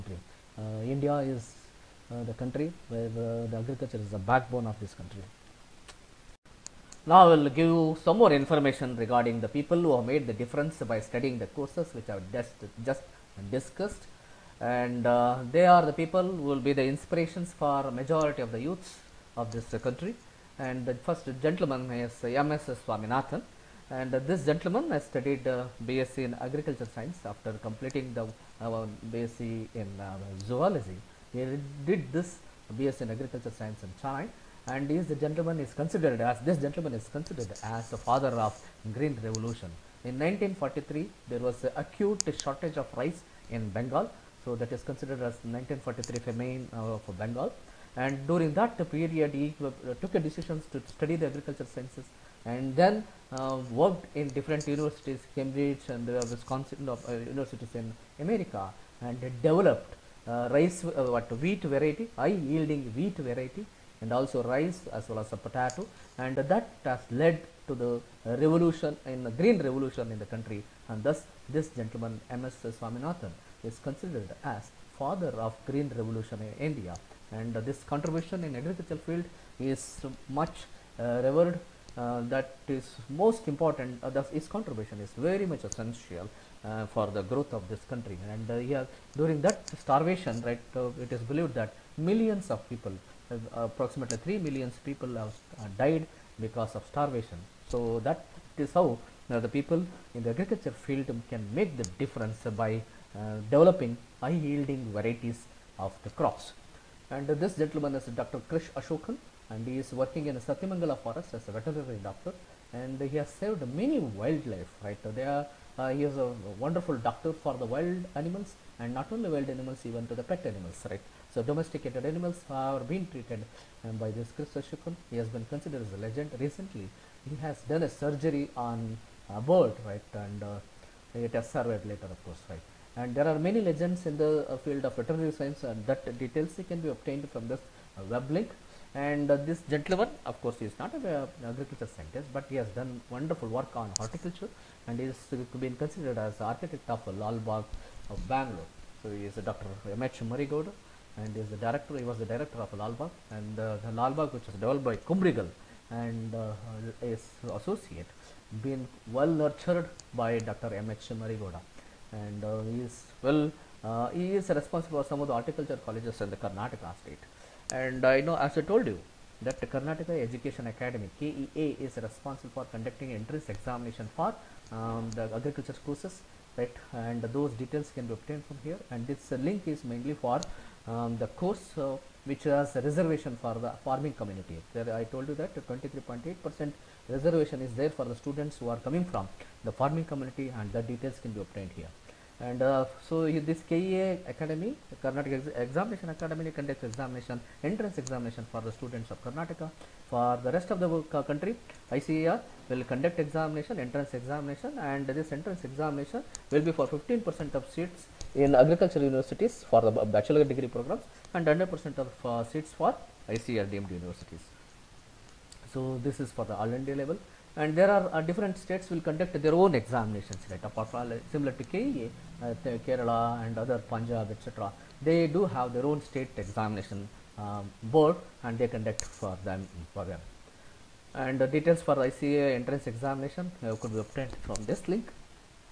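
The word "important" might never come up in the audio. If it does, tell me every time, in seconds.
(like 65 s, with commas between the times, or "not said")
83 s.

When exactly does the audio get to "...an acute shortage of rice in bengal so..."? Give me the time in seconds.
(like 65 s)
41 s.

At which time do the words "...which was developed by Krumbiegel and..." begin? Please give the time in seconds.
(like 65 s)
154 s.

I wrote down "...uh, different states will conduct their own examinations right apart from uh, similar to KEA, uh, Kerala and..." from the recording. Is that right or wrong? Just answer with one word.
right.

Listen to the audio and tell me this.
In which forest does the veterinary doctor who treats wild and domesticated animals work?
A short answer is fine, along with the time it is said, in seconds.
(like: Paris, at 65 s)
Satyamangala forest, at 110 s.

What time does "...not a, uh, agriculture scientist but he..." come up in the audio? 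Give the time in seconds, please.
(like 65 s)
140 s.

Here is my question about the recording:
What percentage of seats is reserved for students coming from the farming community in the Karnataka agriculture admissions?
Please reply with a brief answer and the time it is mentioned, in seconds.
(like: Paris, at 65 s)
23.8%, at 185 s.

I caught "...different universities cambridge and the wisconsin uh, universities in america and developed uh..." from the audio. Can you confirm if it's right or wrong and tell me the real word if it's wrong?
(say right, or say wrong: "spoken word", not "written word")
right.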